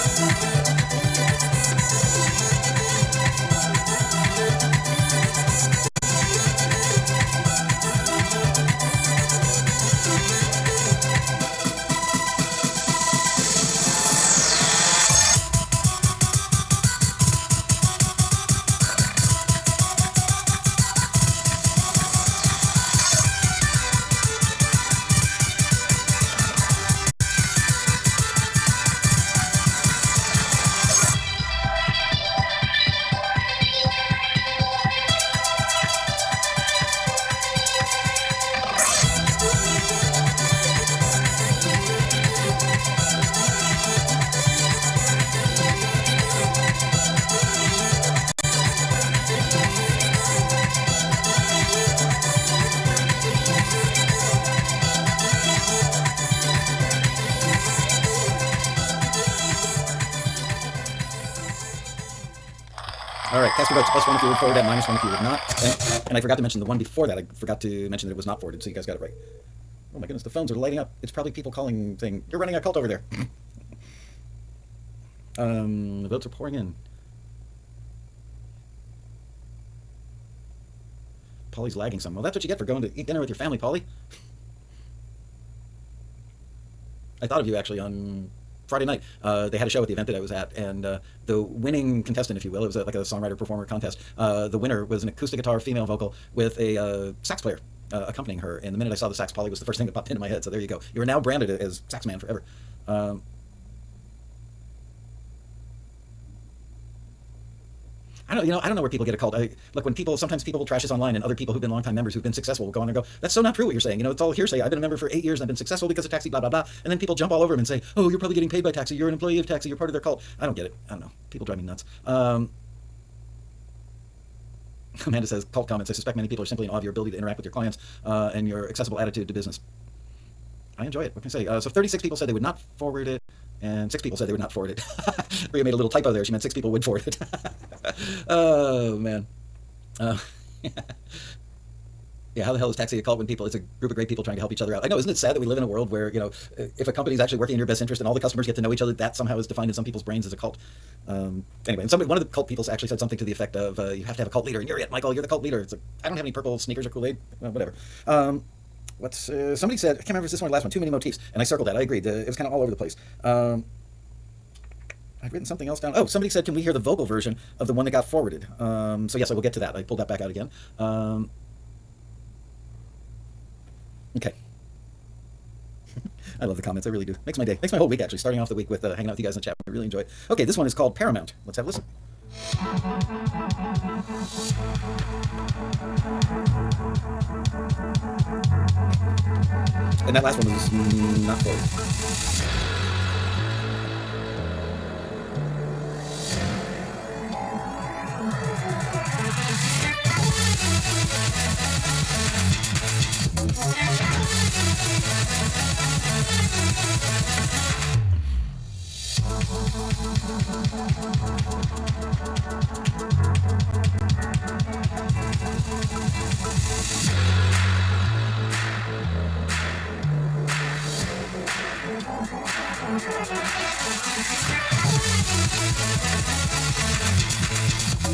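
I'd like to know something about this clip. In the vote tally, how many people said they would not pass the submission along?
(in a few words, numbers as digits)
36.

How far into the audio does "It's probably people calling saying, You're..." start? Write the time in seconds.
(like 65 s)
71 s.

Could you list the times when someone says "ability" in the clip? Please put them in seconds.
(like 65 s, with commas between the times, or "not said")
126 s.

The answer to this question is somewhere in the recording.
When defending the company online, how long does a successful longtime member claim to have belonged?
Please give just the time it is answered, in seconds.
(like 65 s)
115 s.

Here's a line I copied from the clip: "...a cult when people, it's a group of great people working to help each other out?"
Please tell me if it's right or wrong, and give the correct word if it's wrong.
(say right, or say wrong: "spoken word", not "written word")
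wrong: "trying", not "working".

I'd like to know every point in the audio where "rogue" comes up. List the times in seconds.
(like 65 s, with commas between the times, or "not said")
not said.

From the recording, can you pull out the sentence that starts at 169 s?
I pulled that back out again.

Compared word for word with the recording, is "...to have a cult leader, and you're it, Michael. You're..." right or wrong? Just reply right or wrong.
right.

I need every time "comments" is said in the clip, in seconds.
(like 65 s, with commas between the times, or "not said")
125 s, 176 s.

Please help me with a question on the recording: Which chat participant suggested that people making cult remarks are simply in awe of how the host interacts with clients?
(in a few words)
Amanda.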